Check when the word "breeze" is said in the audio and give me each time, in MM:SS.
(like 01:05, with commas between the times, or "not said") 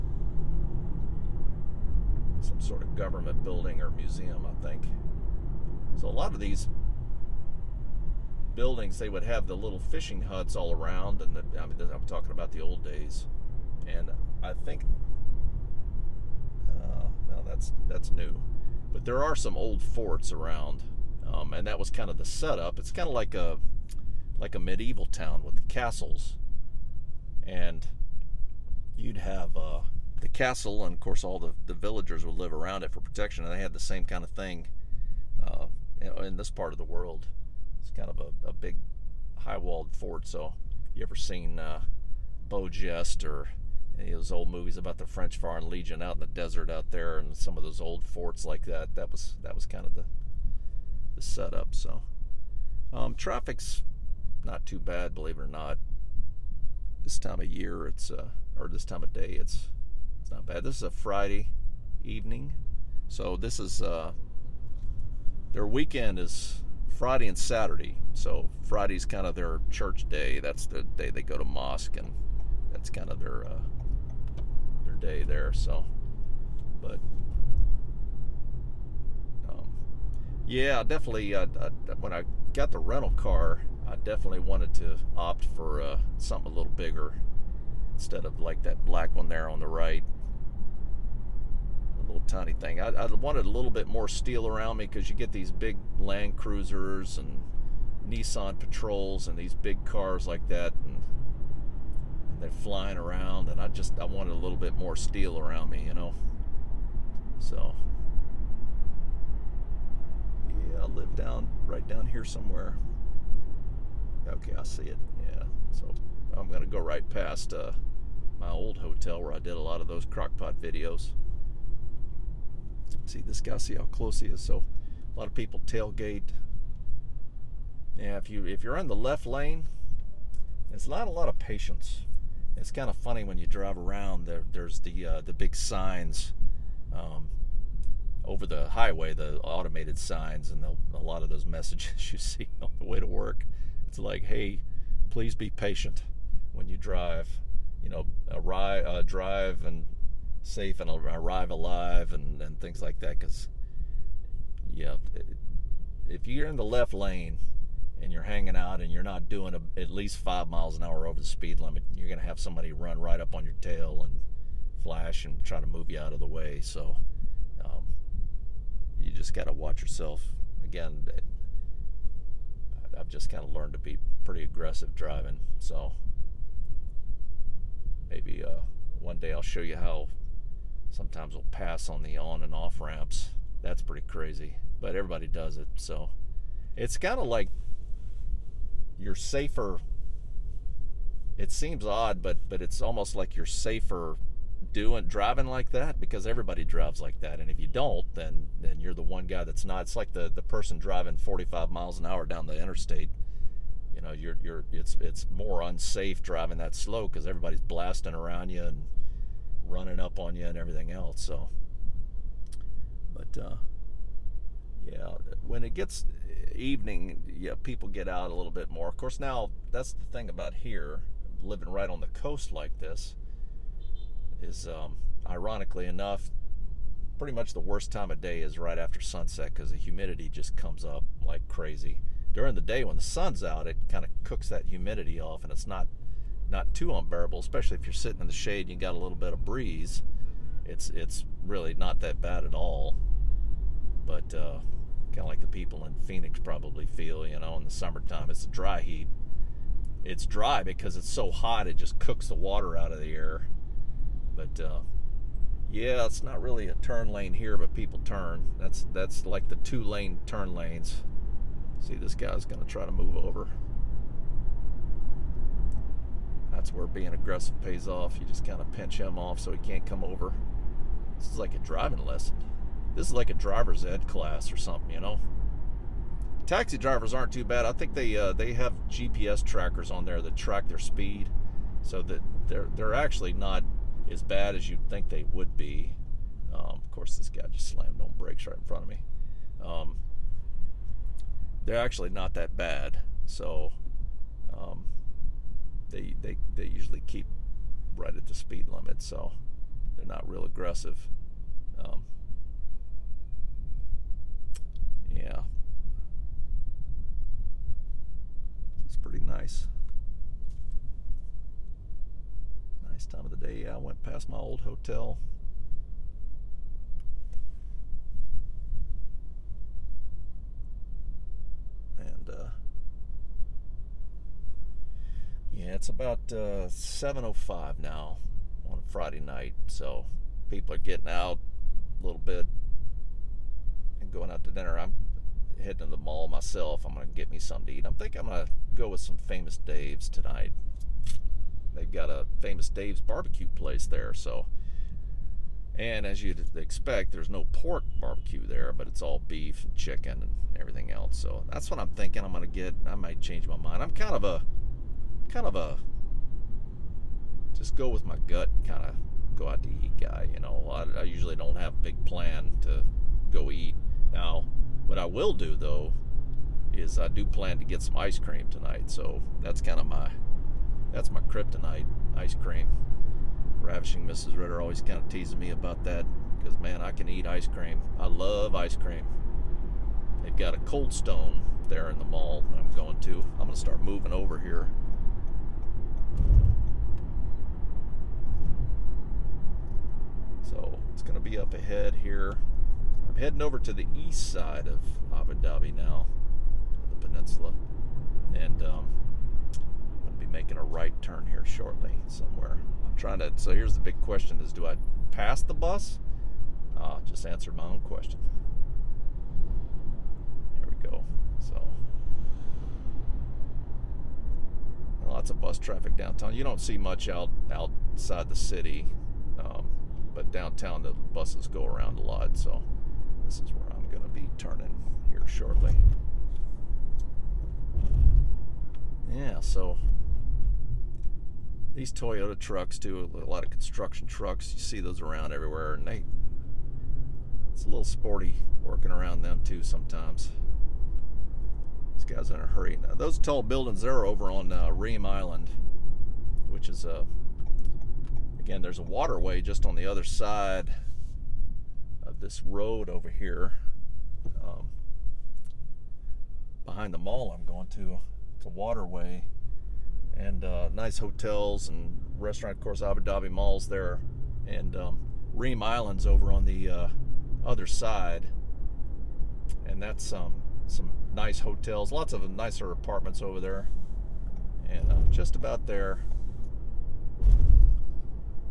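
03:59.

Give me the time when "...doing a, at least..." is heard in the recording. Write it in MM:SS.
02:39.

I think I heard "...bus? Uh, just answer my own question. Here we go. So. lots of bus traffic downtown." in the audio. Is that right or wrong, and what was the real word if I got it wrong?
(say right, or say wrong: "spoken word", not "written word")
right.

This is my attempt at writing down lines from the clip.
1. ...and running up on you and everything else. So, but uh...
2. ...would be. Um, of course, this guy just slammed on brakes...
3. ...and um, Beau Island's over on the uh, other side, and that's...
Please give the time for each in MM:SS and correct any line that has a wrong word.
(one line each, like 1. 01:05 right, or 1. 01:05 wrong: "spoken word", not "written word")
1. 03:28 right
2. 04:45 right
3. 07:44 wrong: "Reem", not "Beau".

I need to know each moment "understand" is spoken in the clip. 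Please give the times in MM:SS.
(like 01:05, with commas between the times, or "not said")
not said.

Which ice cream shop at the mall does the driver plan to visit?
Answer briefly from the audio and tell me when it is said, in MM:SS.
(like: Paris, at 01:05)
Cold Stone, at 06:20.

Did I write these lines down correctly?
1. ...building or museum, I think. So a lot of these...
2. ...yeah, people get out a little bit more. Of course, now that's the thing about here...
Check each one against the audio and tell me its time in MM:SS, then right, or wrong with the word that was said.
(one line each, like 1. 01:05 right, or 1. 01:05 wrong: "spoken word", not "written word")
1. 00:03 right
2. 03:37 right.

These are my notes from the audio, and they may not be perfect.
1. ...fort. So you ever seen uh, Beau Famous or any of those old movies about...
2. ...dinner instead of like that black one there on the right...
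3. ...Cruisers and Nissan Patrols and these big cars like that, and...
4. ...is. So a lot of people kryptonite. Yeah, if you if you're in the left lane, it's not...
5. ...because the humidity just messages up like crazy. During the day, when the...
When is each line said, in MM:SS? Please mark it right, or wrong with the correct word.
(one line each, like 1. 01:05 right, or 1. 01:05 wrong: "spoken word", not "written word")
1. 00:39 wrong: "Geste", not "Famous"
2. 01:26 wrong: "bigger", not "dinner"
3. 01:36 right
4. 02:04 wrong: "tailgate", not "kryptonite"
5. 03:49 wrong: "comes", not "messages".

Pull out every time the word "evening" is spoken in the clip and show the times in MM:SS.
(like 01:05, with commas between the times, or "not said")
01:02, 03:36.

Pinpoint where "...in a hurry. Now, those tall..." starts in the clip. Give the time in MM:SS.
07:22.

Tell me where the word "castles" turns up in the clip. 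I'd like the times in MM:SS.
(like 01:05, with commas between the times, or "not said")
00:25, 00:30.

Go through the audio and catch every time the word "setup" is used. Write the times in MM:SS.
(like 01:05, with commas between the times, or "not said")
00:22, 00:51.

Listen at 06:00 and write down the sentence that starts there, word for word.
You know, I, I usually don't have a big plan to go eat.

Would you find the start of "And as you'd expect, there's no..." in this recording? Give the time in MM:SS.
05:45.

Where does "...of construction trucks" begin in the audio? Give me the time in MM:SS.
07:13.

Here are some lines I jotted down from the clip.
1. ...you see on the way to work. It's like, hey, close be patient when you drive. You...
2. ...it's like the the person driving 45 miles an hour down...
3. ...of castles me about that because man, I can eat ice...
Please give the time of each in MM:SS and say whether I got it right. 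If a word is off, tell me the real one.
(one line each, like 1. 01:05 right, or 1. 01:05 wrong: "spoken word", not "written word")
1. 02:22 wrong: "please", not "close"
2. 03:19 right
3. 06:14 wrong: "teases", not "castles".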